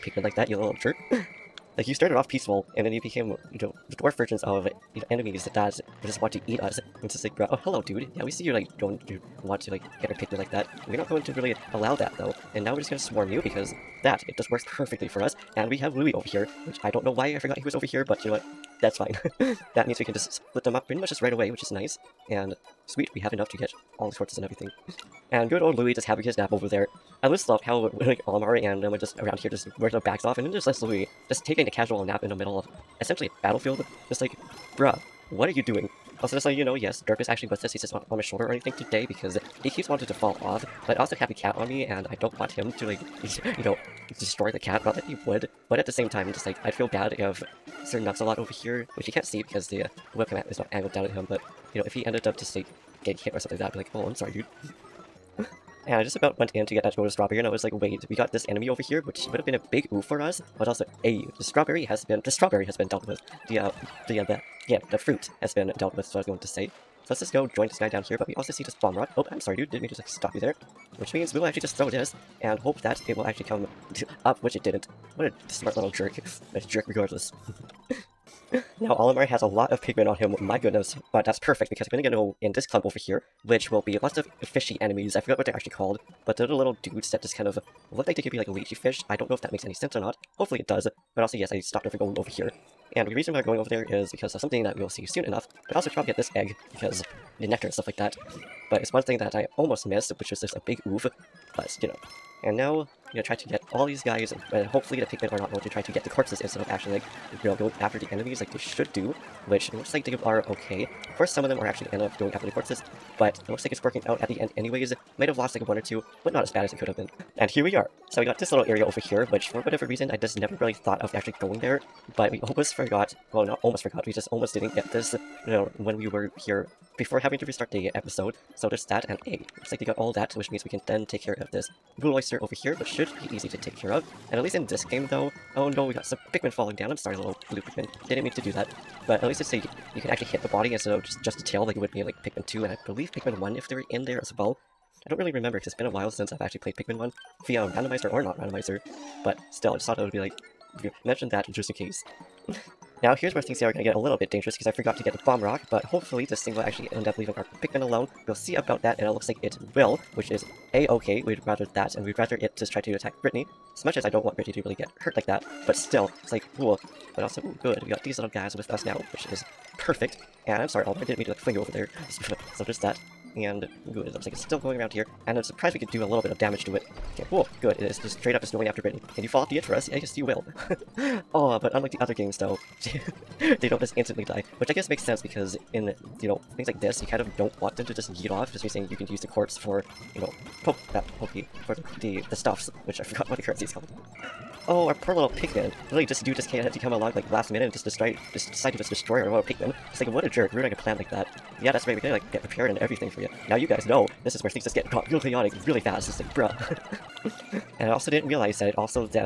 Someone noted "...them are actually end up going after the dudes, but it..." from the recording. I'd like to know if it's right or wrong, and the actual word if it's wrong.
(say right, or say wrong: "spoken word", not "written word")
wrong: "corpses", not "dudes".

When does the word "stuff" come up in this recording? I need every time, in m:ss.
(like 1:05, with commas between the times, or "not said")
1:37, 3:12.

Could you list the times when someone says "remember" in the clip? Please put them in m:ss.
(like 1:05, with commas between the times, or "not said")
2:25.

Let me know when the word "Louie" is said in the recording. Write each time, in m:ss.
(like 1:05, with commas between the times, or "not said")
0:15, 0:25.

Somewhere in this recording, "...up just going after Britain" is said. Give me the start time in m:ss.
2:58.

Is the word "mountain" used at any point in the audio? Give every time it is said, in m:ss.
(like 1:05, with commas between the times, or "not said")
not said.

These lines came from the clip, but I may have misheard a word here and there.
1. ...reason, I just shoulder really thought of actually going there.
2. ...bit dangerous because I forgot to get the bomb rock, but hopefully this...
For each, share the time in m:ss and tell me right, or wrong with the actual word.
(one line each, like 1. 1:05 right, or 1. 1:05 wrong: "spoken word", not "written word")
1. 1:59 wrong: "never", not "shoulder"
2. 2:34 right.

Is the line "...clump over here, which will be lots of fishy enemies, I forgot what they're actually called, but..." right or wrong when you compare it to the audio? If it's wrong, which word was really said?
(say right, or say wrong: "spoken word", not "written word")
right.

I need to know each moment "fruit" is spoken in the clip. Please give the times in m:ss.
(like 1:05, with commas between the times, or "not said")
1:04.